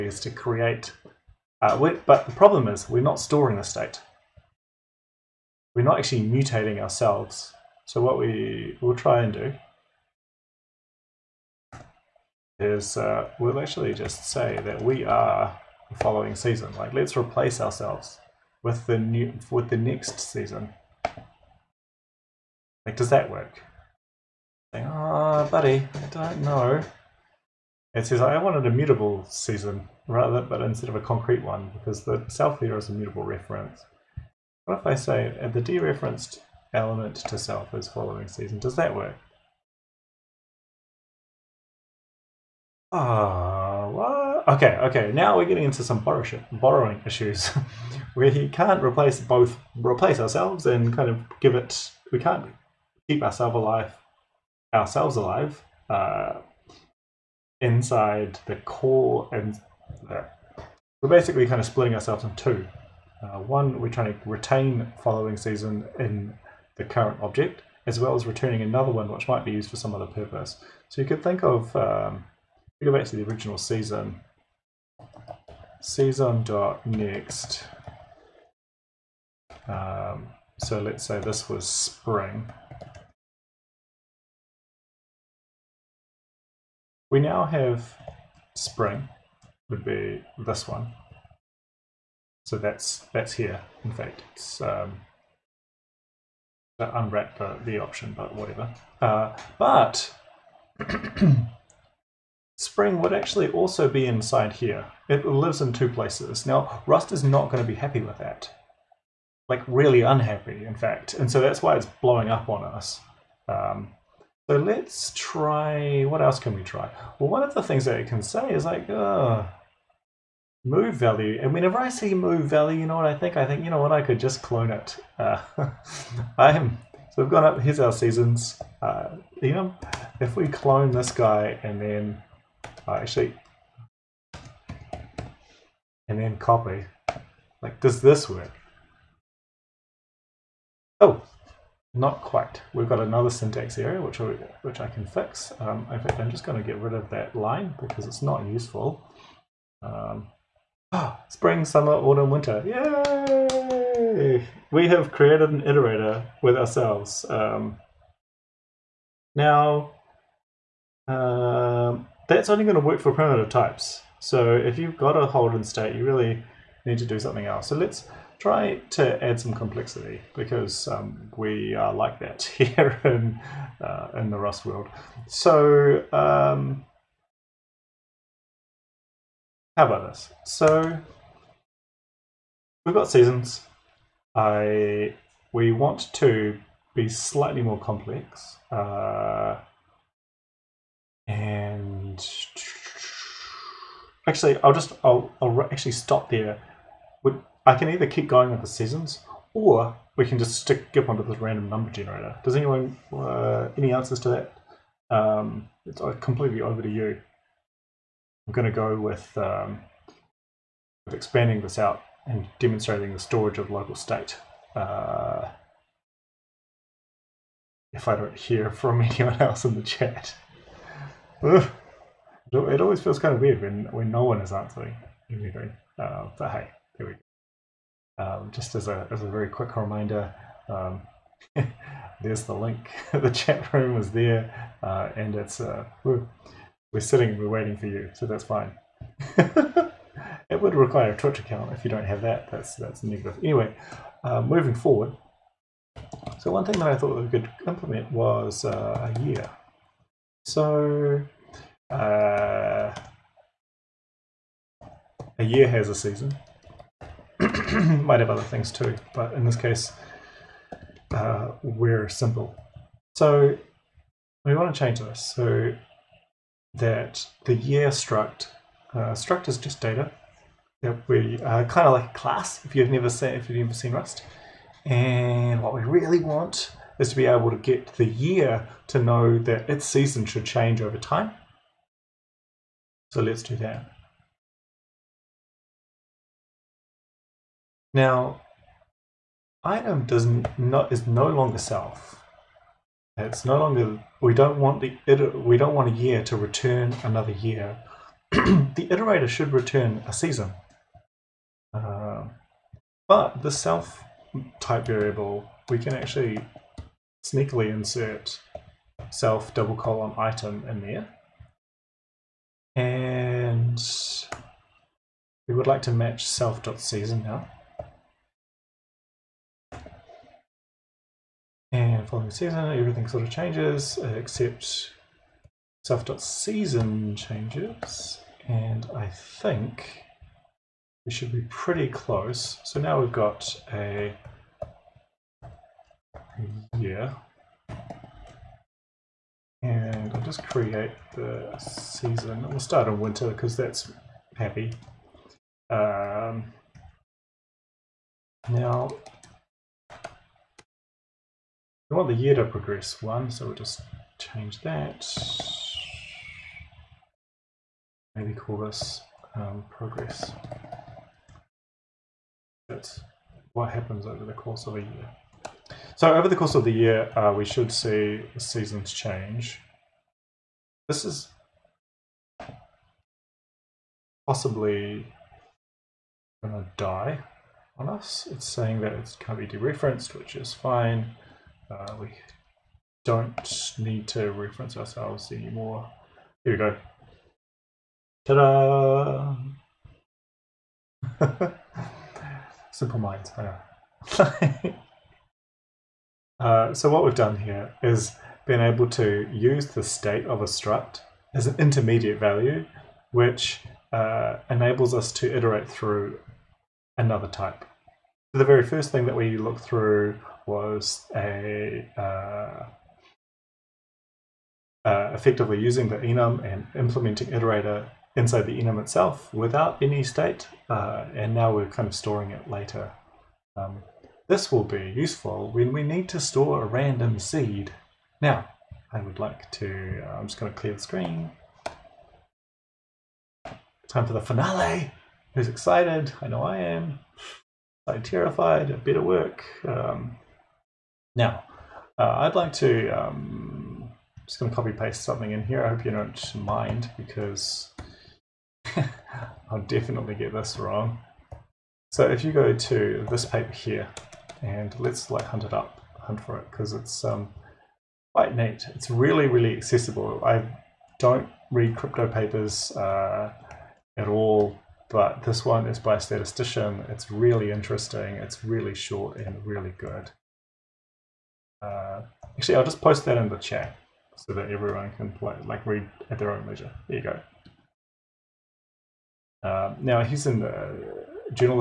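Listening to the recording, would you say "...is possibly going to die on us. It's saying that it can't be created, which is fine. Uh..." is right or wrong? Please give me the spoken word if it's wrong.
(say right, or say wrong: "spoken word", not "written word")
wrong: "dereferenced", not "created".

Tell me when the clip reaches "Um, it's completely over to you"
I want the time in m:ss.
3:25.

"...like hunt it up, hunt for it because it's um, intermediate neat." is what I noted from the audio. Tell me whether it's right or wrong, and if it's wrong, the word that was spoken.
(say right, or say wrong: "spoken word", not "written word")
wrong: "quite", not "intermediate".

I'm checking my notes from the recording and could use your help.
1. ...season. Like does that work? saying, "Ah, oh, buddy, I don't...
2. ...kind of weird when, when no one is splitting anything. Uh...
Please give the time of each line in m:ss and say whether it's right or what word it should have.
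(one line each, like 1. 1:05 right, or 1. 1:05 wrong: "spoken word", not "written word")
1. 0:20 right
2. 3:43 wrong: "answering", not "splitting".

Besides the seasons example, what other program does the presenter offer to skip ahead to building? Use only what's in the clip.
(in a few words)
random number generator.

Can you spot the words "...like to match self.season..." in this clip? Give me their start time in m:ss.
5:15.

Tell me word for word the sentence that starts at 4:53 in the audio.
It's no longer we don't want the we don't want a year to return another year.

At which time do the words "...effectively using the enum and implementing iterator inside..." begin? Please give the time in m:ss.
6:55.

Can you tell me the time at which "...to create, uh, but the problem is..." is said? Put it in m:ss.
0:00.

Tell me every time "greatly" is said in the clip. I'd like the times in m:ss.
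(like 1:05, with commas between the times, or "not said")
not said.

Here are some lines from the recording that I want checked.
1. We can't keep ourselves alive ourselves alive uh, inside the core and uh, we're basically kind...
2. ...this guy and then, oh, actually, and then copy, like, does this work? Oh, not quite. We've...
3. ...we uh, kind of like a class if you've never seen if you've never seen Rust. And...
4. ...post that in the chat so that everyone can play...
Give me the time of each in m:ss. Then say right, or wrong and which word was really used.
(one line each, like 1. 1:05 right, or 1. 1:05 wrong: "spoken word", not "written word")
1. 0:52 right
2. 2:10 right
3. 4:31 right
4. 7:52 right.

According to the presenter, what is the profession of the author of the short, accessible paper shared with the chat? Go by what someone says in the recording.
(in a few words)
statistician.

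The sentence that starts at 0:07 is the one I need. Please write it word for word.
So what we will try and do is uh, we'll actually just say that we are the following season.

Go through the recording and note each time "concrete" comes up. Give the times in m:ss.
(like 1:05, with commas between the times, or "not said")
0:31.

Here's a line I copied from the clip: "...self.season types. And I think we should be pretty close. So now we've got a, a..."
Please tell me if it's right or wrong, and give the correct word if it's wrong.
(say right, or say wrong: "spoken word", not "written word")
wrong: "changes", not "types".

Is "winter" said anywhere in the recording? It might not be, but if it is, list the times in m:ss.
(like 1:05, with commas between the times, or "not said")
2:32, 5:43.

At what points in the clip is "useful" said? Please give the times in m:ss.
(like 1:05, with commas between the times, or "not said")
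2:28, 7:04.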